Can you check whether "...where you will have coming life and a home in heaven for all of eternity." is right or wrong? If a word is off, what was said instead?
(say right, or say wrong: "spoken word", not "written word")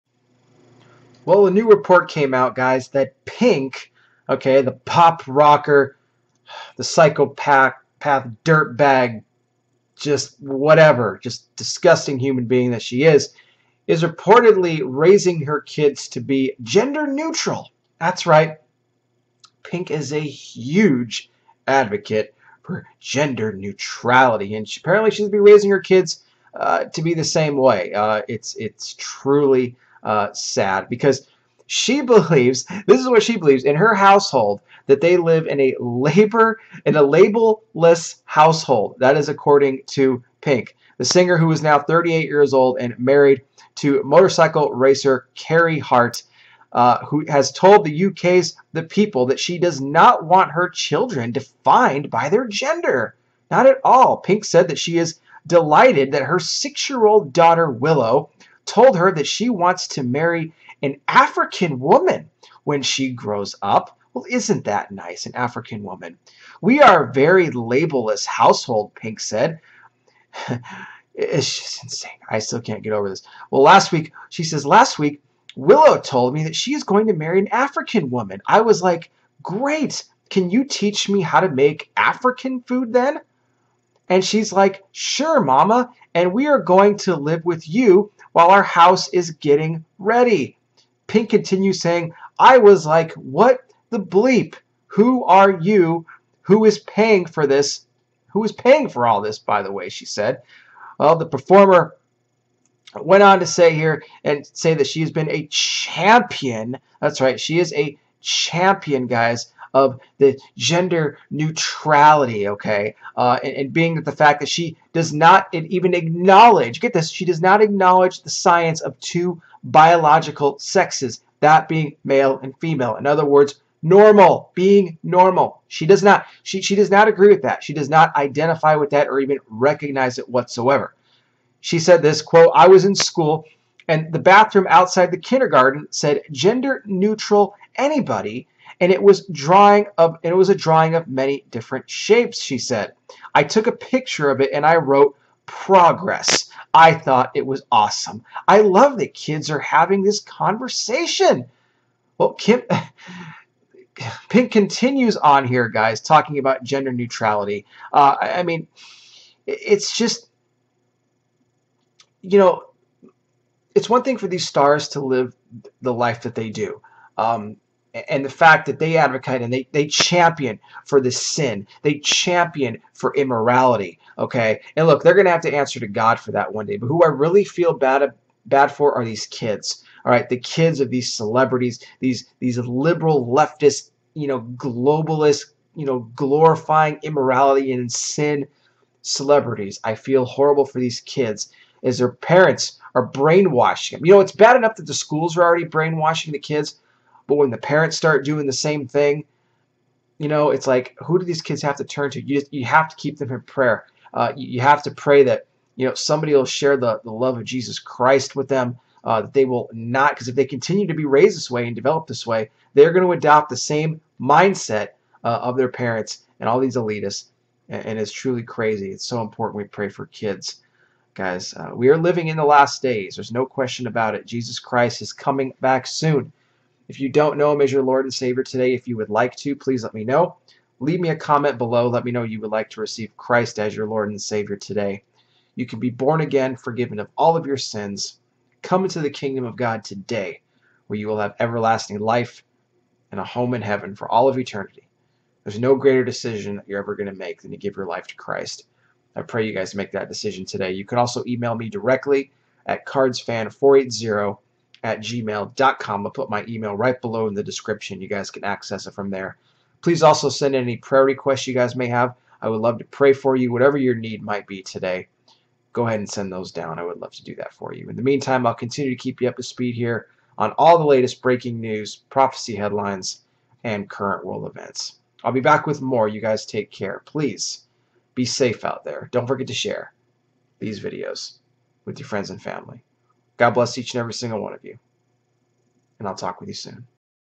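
wrong: "everlasting", not "coming".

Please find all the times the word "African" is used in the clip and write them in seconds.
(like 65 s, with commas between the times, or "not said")
61 s, 65 s, 77 s, 81 s.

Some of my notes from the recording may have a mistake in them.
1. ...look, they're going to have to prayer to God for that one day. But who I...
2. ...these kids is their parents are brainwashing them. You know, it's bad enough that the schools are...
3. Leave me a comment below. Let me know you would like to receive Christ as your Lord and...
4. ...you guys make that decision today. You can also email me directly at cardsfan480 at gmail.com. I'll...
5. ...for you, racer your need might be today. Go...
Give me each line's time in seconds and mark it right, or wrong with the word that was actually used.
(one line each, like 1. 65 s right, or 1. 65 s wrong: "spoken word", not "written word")
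1. 174 s wrong: "answer", not "prayer"
2. 190 s right
3. 230 s right
4. 249 s right
5. 263 s wrong: "whatever", not "racer".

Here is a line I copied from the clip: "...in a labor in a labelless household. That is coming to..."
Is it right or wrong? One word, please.
wrong.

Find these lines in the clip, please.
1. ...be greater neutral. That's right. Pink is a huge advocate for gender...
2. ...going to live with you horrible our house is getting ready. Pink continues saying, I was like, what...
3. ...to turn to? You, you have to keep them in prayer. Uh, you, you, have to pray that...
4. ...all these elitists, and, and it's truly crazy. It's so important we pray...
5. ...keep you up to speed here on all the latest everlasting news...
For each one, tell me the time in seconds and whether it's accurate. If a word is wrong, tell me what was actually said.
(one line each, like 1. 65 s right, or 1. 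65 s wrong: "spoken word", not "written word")
1. 16 s wrong: "gender", not "greater"
2. 86 s wrong: "while", not "horrible"
3. 201 s right
4. 216 s right
5. 269 s wrong: "breaking", not "everlasting".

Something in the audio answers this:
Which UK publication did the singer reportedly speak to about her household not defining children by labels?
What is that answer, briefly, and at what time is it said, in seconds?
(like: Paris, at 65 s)
The People, at 48 s.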